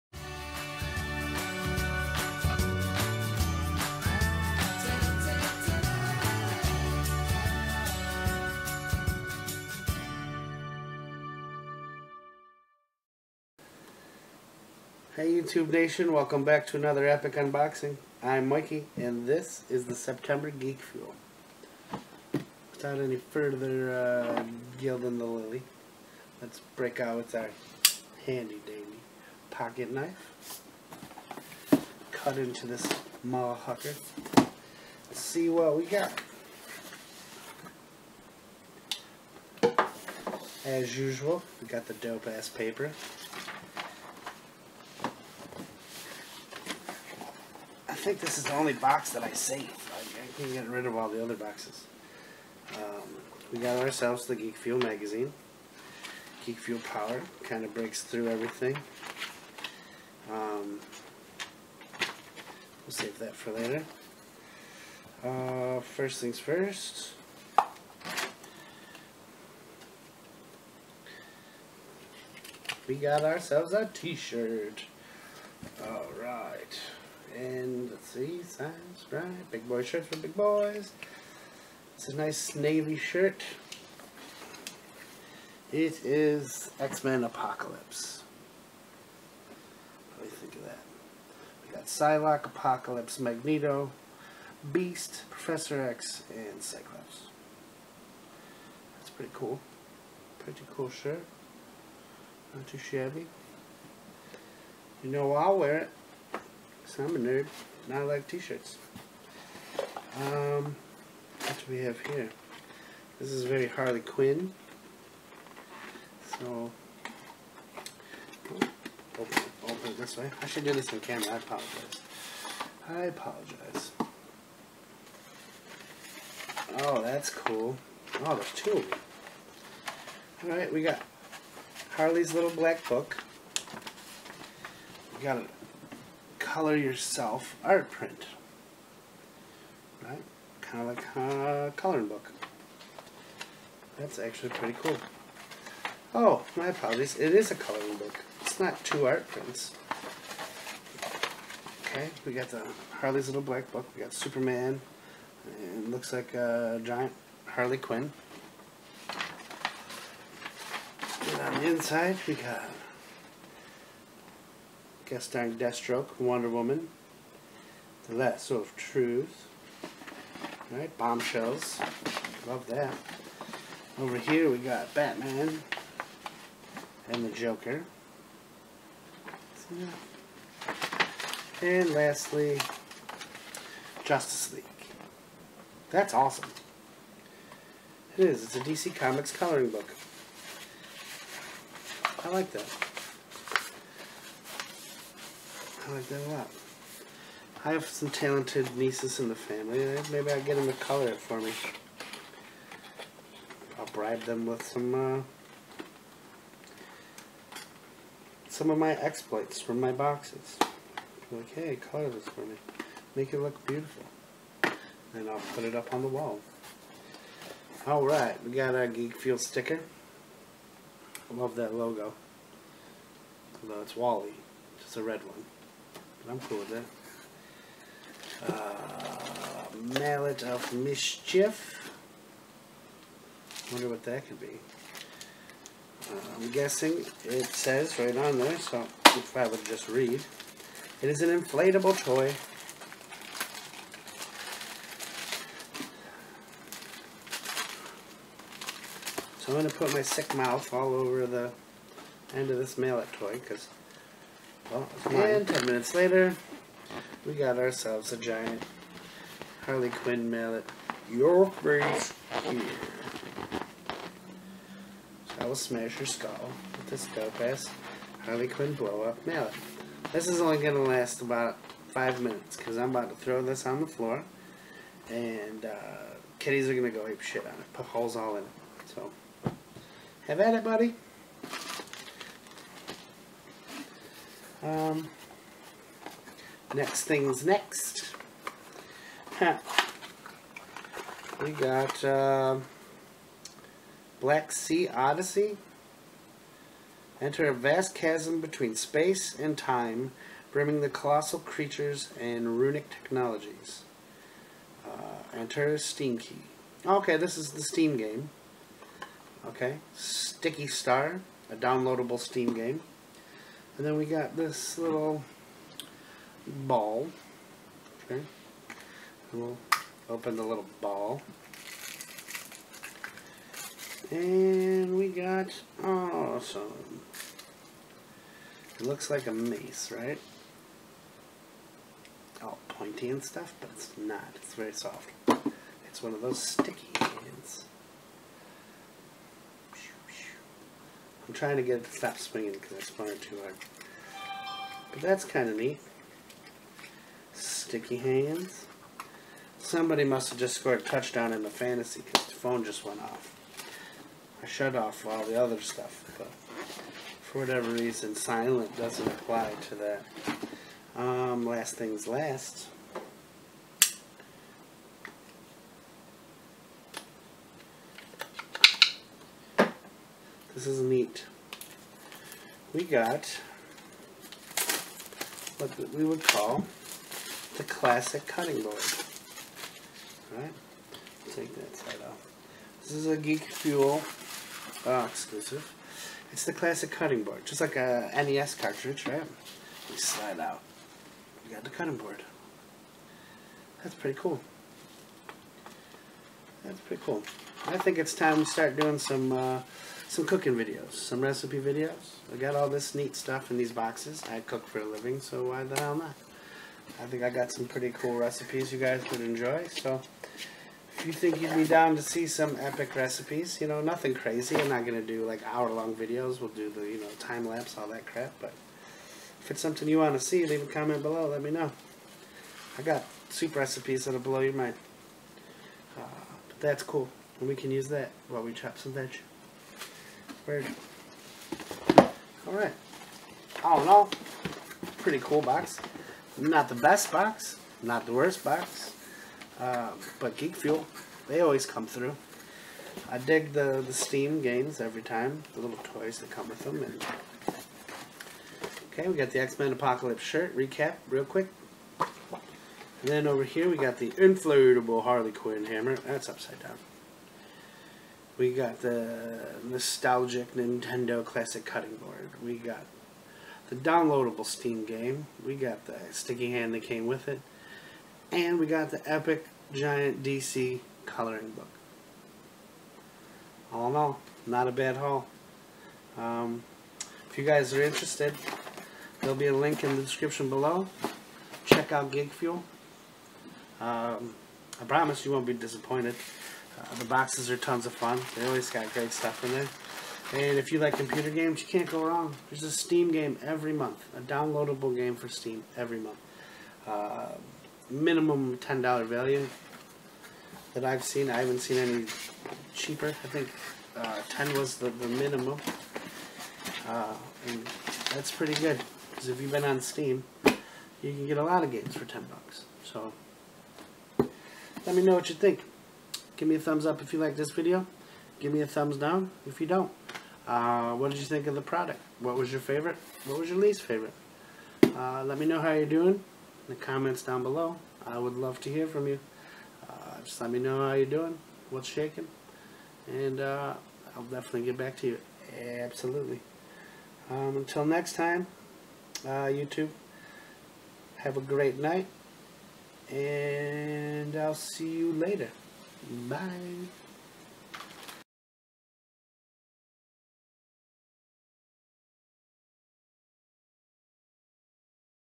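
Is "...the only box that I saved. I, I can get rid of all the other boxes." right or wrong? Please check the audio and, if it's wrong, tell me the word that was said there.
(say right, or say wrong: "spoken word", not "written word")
right.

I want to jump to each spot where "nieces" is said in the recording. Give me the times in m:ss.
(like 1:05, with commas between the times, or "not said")
3:18.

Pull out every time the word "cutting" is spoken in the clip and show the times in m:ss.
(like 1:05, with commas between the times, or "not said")
6:18, 6:26, 6:31, 7:41.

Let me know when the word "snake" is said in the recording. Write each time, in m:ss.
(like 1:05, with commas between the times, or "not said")
not said.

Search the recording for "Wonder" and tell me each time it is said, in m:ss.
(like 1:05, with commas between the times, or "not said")
2:46, 3:53.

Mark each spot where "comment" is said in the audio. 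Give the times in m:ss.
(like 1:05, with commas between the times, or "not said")
7:00, 8:46.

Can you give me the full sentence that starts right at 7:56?
Um, if you guys are interested, there'll be a link in the description below.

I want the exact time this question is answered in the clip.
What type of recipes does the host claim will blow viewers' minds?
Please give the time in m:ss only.
7:03.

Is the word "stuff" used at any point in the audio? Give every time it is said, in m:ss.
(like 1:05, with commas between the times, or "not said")
5:33, 5:55, 6:43, 8:09.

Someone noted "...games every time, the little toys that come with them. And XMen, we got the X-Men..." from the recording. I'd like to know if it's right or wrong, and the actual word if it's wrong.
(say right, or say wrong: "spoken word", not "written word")
wrong: "Okay", not "XMen".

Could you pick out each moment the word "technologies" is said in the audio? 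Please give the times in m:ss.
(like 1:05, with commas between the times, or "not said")
5:02.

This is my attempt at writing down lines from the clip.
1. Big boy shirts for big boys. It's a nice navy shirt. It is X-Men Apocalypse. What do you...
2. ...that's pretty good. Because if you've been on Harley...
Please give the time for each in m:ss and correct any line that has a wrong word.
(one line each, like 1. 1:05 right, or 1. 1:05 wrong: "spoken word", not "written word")
1. 1:19 right
2. 8:28 wrong: "Steam", not "Harley".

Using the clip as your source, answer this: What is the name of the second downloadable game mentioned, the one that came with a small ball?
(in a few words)
Sticky Star.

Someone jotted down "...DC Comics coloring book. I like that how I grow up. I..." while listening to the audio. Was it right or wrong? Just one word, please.
right.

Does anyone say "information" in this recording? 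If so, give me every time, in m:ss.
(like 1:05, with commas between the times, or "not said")
not said.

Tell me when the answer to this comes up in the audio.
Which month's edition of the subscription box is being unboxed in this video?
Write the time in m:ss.
0:19.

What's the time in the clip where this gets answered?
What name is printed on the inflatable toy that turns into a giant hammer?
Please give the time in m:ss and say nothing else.
3:49.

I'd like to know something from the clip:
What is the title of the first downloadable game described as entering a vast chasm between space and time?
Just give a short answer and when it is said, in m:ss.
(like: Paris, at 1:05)
Black Sea Odyssey, at 4:54.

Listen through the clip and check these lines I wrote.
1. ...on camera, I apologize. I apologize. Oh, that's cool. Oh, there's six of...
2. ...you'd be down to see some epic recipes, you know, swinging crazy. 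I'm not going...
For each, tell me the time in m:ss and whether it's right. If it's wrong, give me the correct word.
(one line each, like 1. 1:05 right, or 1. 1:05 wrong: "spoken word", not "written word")
1. 2:00 wrong: "two", not "six"
2. 6:51 wrong: "nothing", not "swinging".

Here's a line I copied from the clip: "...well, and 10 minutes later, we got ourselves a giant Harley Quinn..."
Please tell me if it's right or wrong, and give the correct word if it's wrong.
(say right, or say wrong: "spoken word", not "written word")
right.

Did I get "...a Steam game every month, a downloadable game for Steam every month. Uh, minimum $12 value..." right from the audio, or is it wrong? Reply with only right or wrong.
wrong.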